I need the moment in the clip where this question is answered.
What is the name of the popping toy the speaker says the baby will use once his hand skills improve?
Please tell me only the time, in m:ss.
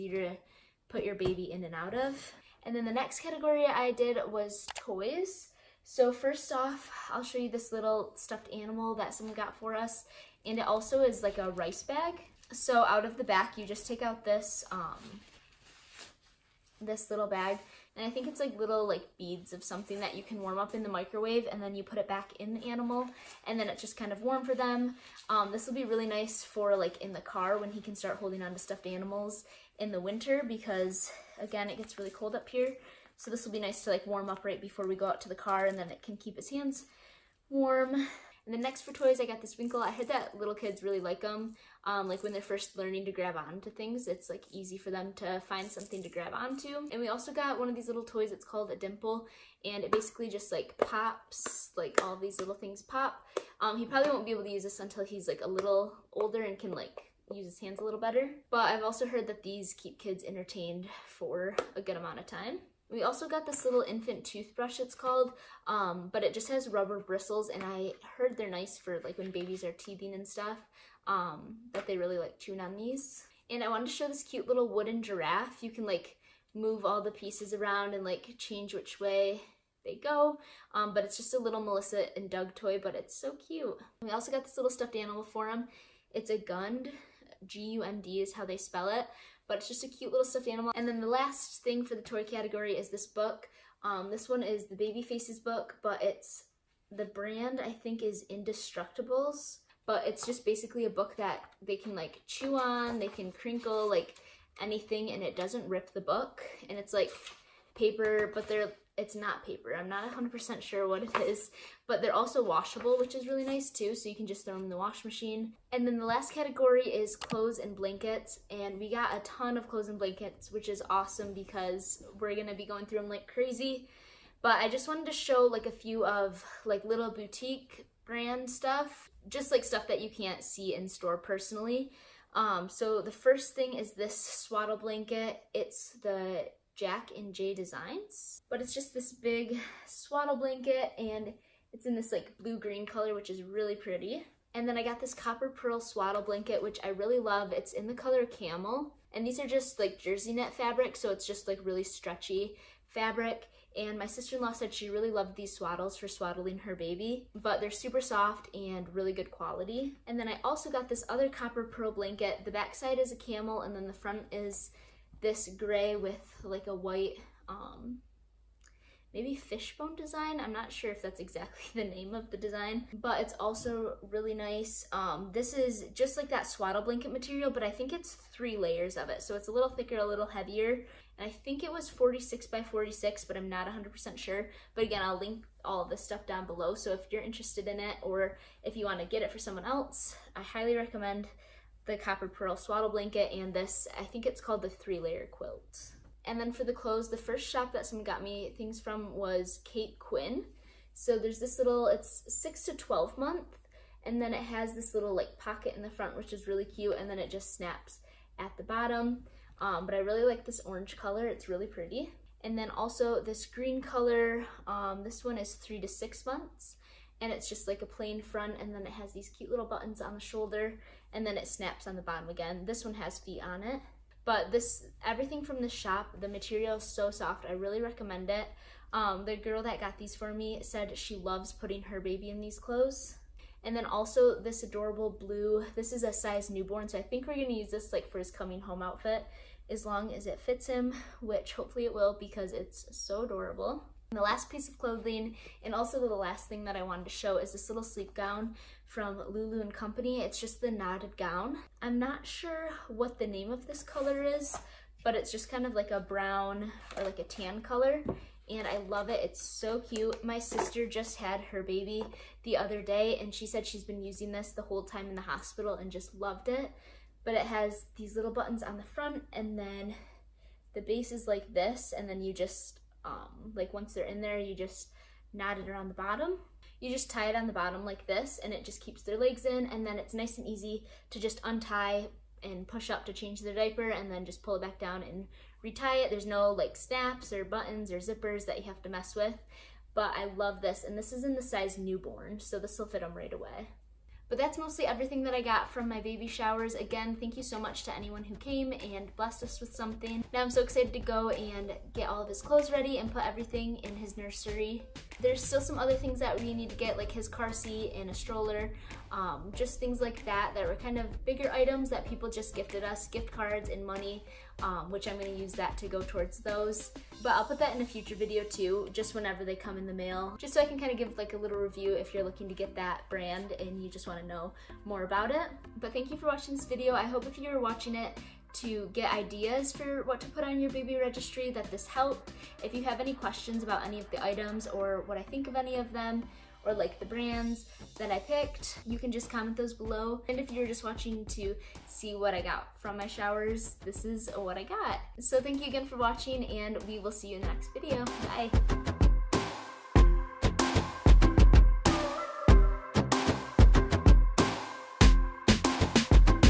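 0:48.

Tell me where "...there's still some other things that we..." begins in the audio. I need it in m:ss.
5:05.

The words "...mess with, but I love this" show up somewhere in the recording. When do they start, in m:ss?
4:48.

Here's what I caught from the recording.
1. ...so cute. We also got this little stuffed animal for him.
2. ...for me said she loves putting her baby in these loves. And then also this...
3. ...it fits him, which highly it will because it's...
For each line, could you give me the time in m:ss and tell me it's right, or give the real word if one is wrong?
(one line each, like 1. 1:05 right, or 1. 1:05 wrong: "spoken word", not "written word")
1. 1:23 right
2. 3:50 wrong: "clothes", not "loves"
3. 4:00 wrong: "hopefully", not "highly".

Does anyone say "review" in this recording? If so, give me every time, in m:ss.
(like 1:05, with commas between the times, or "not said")
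5:21.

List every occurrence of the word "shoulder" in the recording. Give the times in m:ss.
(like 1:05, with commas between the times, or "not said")
3:40.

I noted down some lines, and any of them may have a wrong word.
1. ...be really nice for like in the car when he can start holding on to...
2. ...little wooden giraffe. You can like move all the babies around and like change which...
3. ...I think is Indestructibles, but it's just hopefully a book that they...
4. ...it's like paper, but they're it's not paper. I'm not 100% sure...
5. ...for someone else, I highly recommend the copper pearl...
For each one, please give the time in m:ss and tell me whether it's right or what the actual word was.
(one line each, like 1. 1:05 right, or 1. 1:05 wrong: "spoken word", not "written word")
1. 0:25 right
2. 1:14 wrong: "pieces", not "babies"
3. 1:37 wrong: "basically", not "hopefully"
4. 1:46 right
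5. 3:09 right.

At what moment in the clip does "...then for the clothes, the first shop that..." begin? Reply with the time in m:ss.
3:16.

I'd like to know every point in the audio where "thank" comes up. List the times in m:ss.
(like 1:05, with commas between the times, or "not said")
4:57, 5:25, 5:45.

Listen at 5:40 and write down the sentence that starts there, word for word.
And if you're just watching to see what I got from my showers, this is what I got.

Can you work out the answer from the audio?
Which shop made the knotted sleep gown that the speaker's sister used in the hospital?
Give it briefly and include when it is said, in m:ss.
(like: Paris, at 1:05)
Lulu and Company, at 4:09.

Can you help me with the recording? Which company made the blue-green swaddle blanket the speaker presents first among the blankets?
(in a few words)
Jack and Jay Designs.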